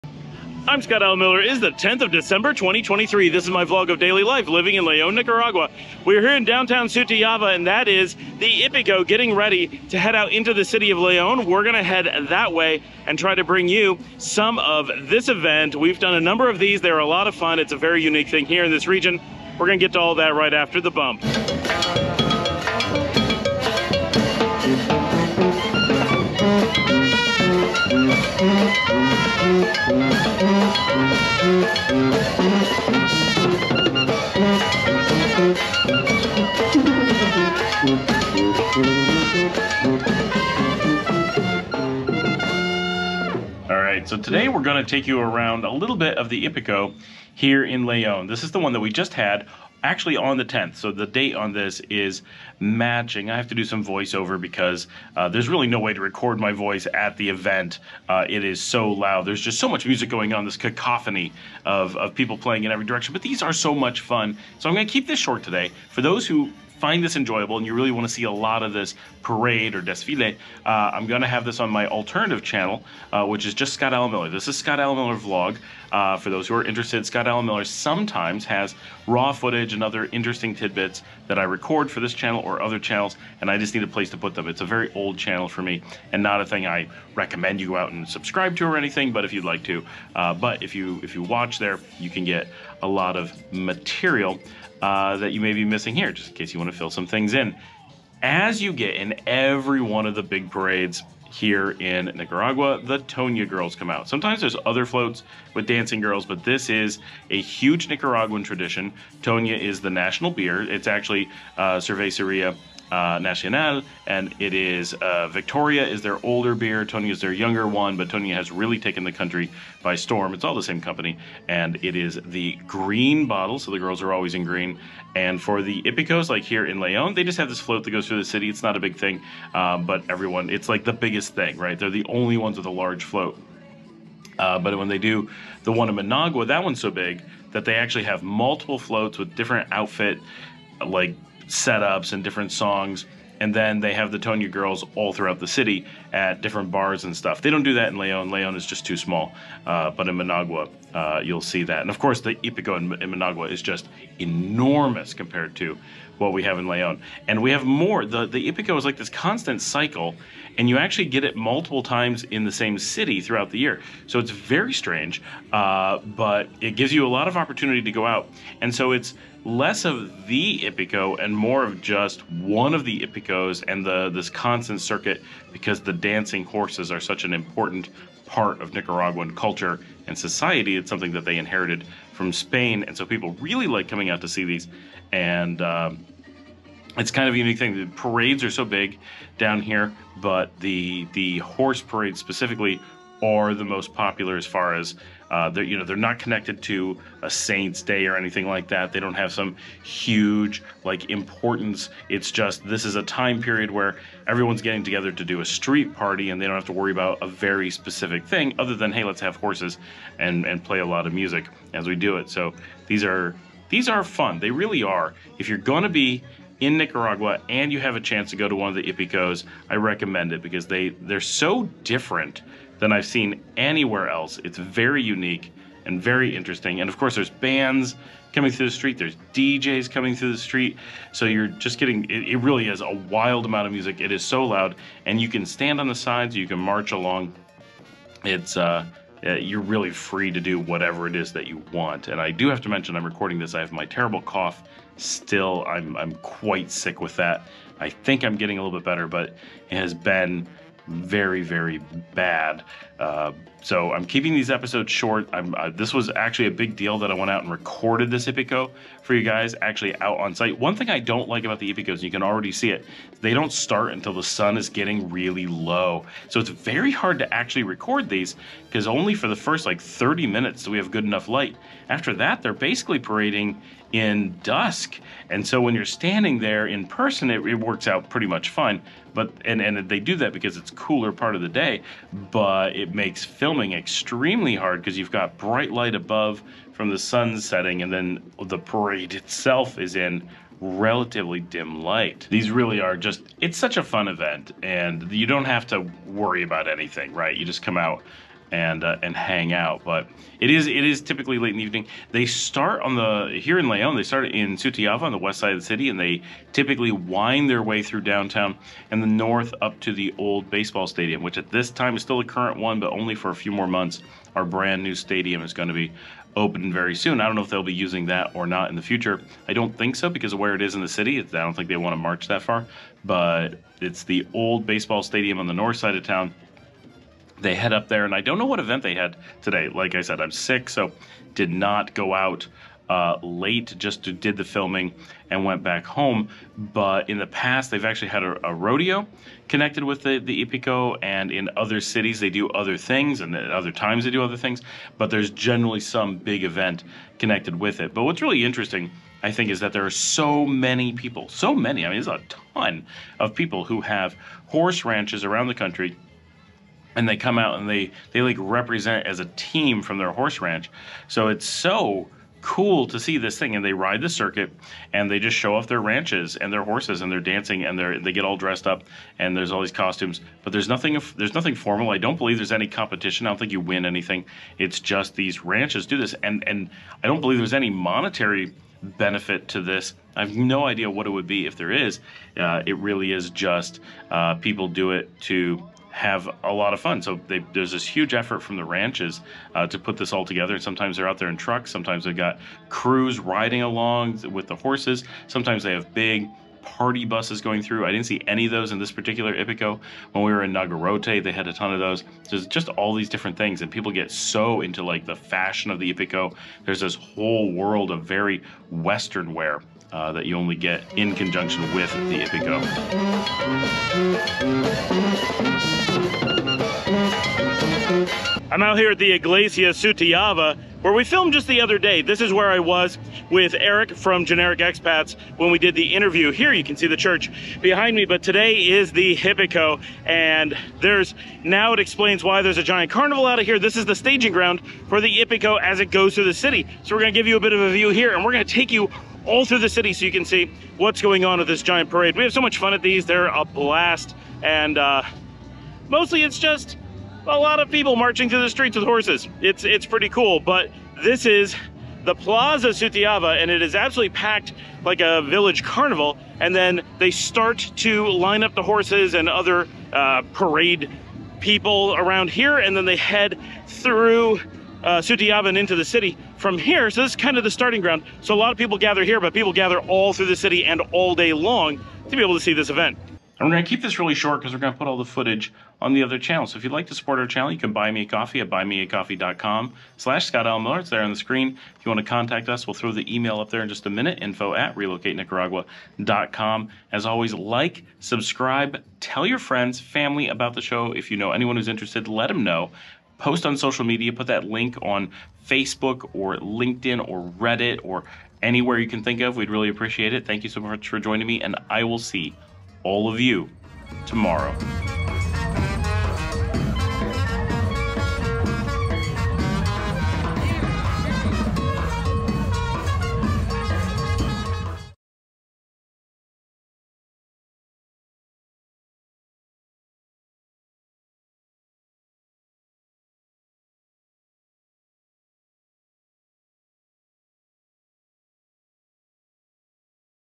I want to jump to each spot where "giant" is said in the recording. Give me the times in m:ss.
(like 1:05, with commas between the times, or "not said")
7:12, 7:21.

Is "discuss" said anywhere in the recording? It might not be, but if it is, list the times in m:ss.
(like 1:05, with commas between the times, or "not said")
not said.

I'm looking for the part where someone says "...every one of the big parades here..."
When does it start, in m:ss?
1:39.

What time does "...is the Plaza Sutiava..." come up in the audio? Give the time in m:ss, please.
7:31.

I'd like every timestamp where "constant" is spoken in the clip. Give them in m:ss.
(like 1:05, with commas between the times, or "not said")
2:39, 2:54.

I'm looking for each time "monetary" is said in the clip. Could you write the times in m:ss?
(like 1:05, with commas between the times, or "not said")
6:17.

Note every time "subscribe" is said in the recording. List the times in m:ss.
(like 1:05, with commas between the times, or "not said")
1:28, 8:07.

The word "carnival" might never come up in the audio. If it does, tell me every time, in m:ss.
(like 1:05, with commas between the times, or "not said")
7:12, 7:35.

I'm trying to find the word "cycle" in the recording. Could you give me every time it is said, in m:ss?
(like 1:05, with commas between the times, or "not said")
2:39.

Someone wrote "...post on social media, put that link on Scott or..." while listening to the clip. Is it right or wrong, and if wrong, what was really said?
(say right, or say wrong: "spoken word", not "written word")
wrong: "Facebook", not "Scott".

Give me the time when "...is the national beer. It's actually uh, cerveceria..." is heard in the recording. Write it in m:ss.
1:49.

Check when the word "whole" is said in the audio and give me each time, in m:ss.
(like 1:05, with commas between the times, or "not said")
6:46.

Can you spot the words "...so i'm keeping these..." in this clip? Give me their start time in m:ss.
4:13.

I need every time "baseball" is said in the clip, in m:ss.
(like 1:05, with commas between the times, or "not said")
5:10, 5:24.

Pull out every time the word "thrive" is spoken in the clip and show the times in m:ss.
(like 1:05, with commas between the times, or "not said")
not said.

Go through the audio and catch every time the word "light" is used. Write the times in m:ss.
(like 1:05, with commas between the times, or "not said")
4:31, 4:45, 4:51.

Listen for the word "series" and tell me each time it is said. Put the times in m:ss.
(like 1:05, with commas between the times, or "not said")
not said.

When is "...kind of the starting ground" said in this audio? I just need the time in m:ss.
7:47.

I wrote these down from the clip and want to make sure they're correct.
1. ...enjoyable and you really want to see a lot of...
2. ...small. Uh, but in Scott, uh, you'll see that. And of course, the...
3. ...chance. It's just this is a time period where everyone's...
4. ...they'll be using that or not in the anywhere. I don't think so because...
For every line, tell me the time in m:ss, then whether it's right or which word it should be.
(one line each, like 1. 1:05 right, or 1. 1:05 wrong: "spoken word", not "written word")
1. 1:07 right
2. 2:28 wrong: "Managua", not "Scott"
3. 3:21 wrong: "importance", not "chance"
4. 5:17 wrong: "future", not "anywhere".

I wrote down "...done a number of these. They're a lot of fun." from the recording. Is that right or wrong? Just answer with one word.
right.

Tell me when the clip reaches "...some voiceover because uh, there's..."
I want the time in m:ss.
0:53.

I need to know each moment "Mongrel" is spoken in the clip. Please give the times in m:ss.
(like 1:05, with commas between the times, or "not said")
not said.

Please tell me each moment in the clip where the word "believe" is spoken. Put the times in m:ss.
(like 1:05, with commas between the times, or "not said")
6:12, 6:17.